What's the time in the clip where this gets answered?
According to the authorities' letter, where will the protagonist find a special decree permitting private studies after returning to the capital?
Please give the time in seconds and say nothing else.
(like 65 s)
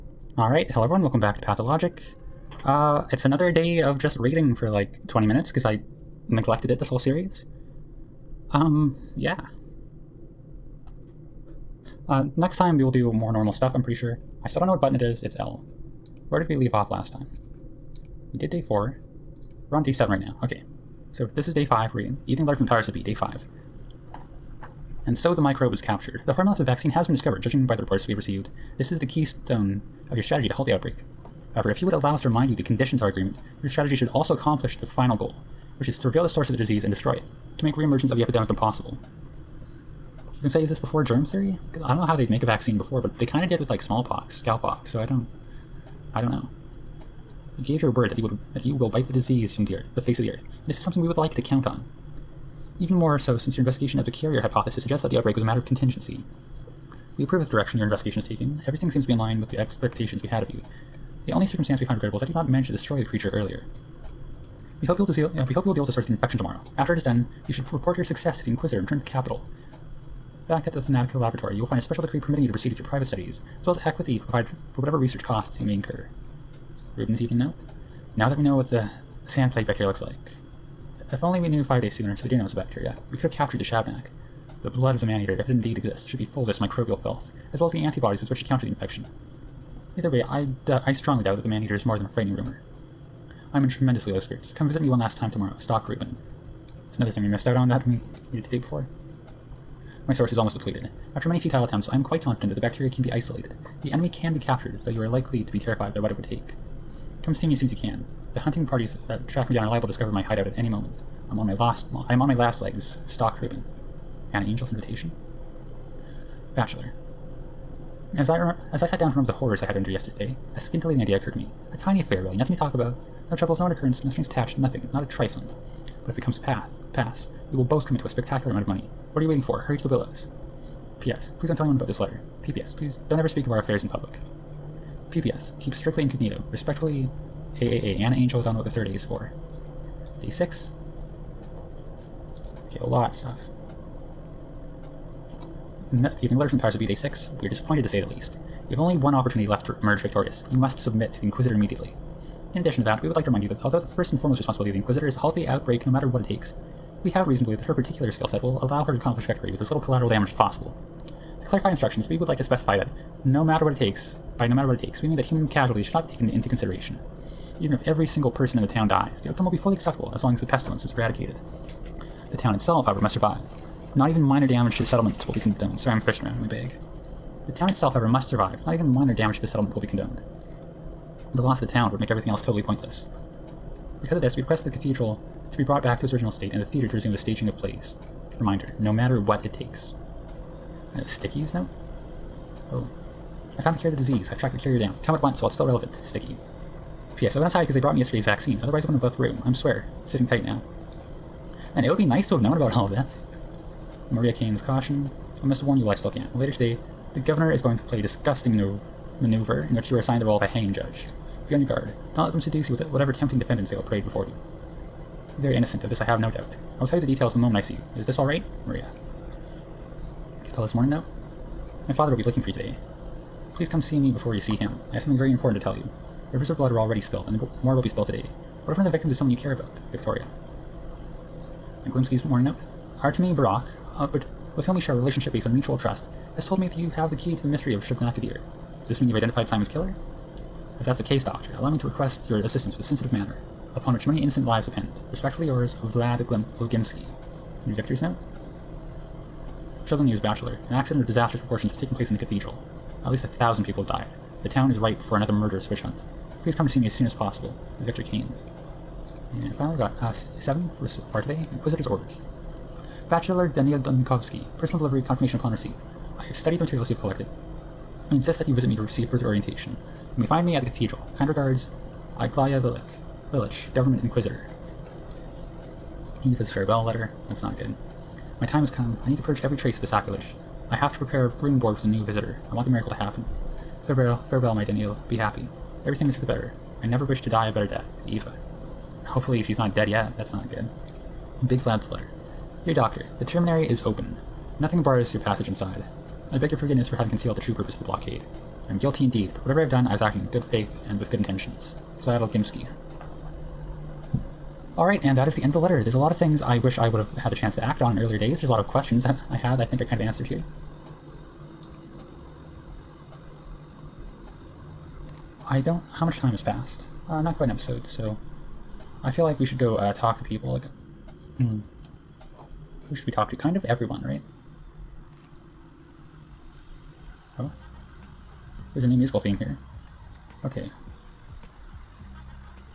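70 s.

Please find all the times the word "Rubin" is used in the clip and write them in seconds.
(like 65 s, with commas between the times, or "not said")
95 s, 113 s.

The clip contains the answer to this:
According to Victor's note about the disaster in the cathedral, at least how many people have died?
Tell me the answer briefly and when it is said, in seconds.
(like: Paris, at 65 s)
1000, at 253 s.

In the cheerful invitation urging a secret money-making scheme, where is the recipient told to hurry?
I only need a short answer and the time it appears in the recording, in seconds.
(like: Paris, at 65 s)
the willows, at 129 s.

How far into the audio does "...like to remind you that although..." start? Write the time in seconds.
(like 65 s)
153 s.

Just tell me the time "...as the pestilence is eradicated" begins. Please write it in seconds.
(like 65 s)
170 s.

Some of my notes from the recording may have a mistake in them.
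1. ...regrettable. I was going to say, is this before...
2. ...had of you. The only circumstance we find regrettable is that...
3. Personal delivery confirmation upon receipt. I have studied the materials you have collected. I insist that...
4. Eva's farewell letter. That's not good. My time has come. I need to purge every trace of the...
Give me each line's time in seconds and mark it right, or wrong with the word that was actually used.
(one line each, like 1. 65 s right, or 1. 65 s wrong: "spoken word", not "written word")
1. 38 s wrong: "impossible", not "regrettable"
2. 60 s right
3. 264 s right
4. 276 s right.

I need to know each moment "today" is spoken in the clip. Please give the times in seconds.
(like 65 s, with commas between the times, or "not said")
206 s, 222 s, 228 s, 261 s.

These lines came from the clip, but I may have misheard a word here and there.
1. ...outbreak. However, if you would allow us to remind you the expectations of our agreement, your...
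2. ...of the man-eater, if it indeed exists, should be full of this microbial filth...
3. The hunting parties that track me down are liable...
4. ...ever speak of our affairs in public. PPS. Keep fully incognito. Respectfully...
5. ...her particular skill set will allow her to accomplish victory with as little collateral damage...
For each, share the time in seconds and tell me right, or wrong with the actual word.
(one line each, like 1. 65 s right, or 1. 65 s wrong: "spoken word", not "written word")
1. 30 s wrong: "conditions", not "expectations"
2. 84 s right
3. 108 s right
4. 133 s wrong: "strictly", not "fully"
5. 157 s right.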